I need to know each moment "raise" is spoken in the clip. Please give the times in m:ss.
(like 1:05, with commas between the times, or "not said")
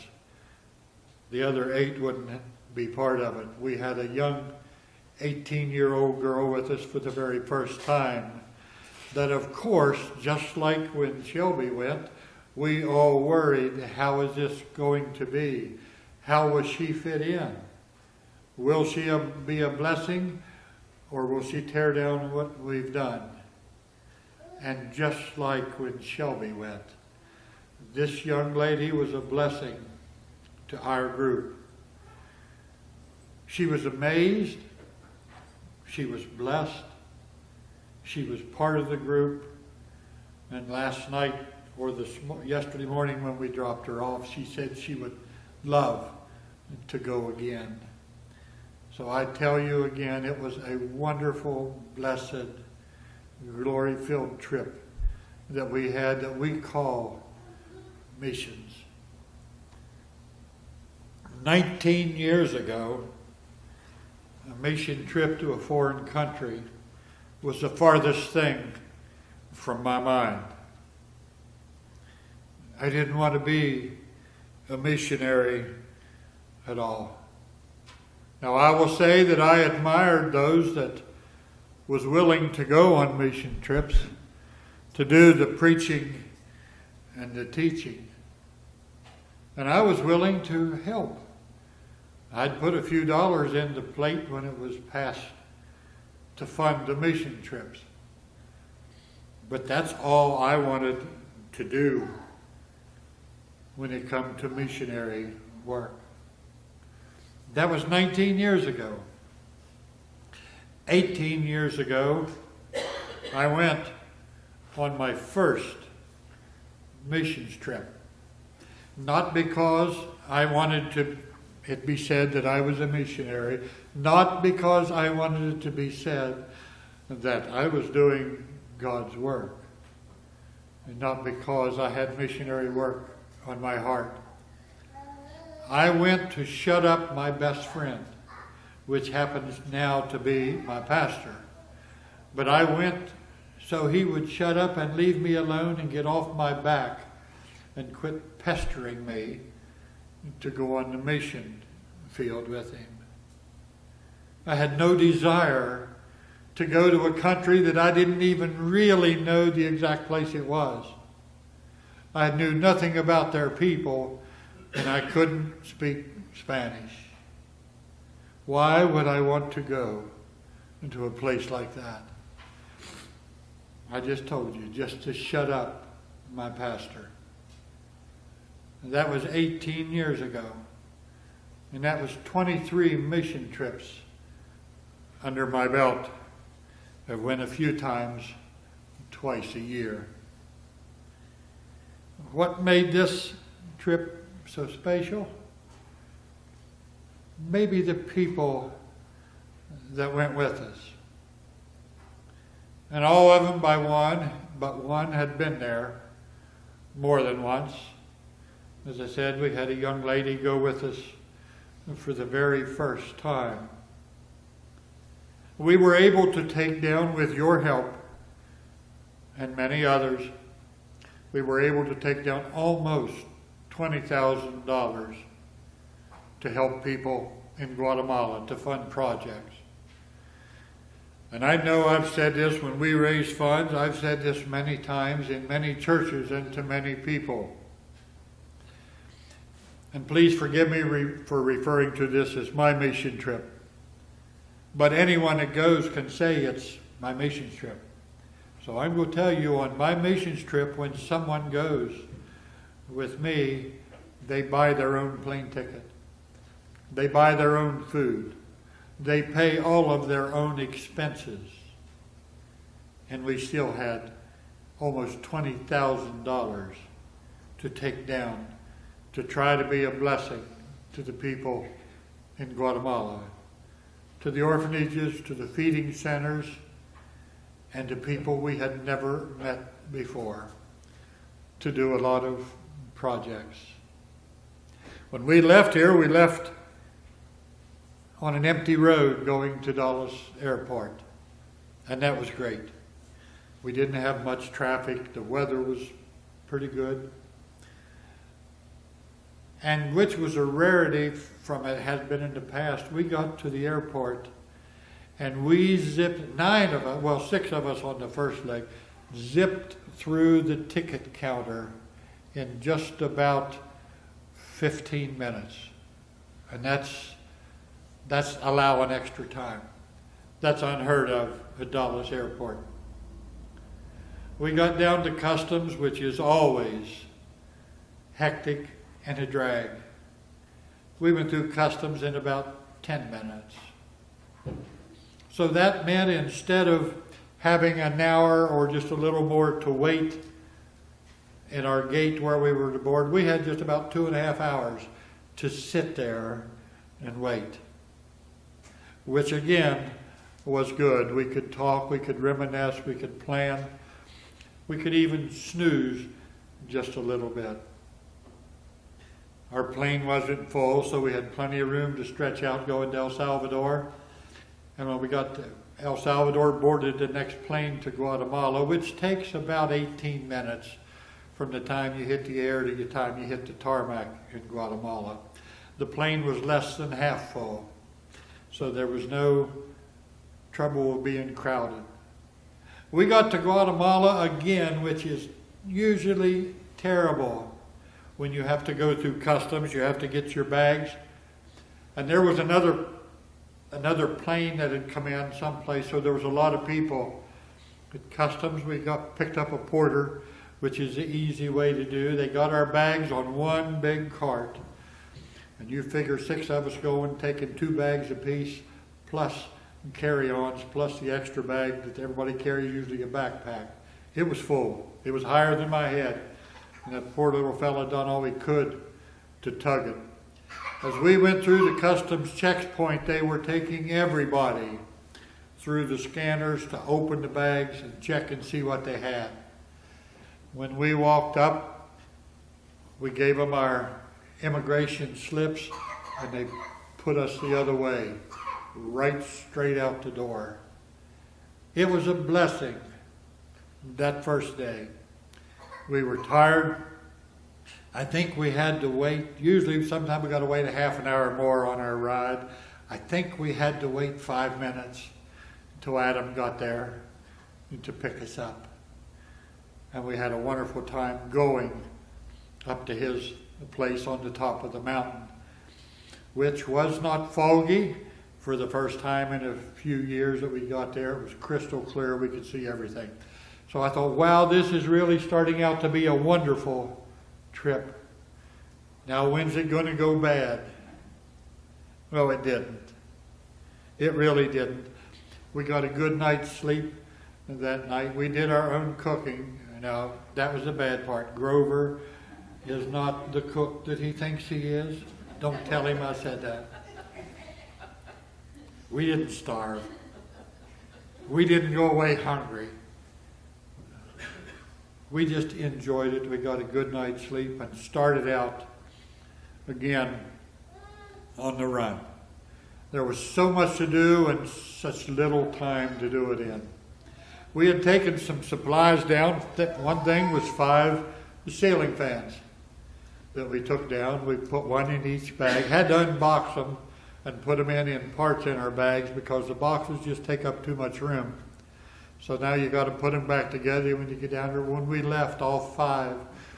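3:52.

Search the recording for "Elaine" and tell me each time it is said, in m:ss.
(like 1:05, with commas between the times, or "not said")
not said.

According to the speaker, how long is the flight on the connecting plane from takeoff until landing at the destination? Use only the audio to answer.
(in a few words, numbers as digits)
18 minutes.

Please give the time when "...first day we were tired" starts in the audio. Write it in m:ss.
7:24.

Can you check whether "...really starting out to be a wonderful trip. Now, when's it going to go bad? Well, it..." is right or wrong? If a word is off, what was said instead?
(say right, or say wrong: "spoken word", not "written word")
right.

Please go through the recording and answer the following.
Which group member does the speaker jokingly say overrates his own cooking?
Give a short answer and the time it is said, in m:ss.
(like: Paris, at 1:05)
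Grover, at 8:11.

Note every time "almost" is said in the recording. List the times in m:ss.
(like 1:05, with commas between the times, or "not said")
3:42, 4:24.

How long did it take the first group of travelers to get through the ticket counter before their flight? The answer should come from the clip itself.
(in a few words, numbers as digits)
15 minutes.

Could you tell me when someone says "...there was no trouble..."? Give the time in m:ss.
6:18.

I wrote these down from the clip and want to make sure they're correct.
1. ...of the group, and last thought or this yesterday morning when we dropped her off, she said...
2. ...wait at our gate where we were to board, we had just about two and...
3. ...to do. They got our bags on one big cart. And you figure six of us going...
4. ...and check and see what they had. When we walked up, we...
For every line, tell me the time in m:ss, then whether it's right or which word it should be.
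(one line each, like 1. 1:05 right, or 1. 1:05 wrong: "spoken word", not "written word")
1. 0:38 wrong: "night", not "thought"
2. 5:39 right
3. 6:41 right
4. 7:07 right.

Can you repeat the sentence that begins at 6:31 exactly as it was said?
And there was another another plane that had come in someplace, so there was a lot of people.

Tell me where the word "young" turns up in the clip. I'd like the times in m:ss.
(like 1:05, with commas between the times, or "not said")
0:04, 0:28, 3:29.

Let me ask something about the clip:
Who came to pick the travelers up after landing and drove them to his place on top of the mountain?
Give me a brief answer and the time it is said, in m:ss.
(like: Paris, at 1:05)
Adam, at 7:35.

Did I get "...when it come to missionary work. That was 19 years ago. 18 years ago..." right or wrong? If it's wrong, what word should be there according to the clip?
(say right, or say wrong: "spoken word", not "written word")
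right.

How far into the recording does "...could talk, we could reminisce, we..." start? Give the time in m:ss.
5:51.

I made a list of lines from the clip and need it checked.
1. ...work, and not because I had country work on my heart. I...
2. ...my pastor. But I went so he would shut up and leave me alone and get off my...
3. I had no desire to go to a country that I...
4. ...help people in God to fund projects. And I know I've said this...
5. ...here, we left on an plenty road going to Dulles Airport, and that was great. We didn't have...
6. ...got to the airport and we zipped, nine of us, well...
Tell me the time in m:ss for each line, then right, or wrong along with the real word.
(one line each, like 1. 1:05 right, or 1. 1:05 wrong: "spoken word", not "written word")
1. 2:09 wrong: "missionary", not "country"
2. 2:20 right
3. 2:34 right
4. 3:46 wrong: "Guatemala", not "God"
5. 4:45 wrong: "empty", not "plenty"
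6. 5:03 right.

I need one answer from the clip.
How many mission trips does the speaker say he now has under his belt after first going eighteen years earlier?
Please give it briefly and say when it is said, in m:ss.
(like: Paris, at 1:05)
23, at 3:02.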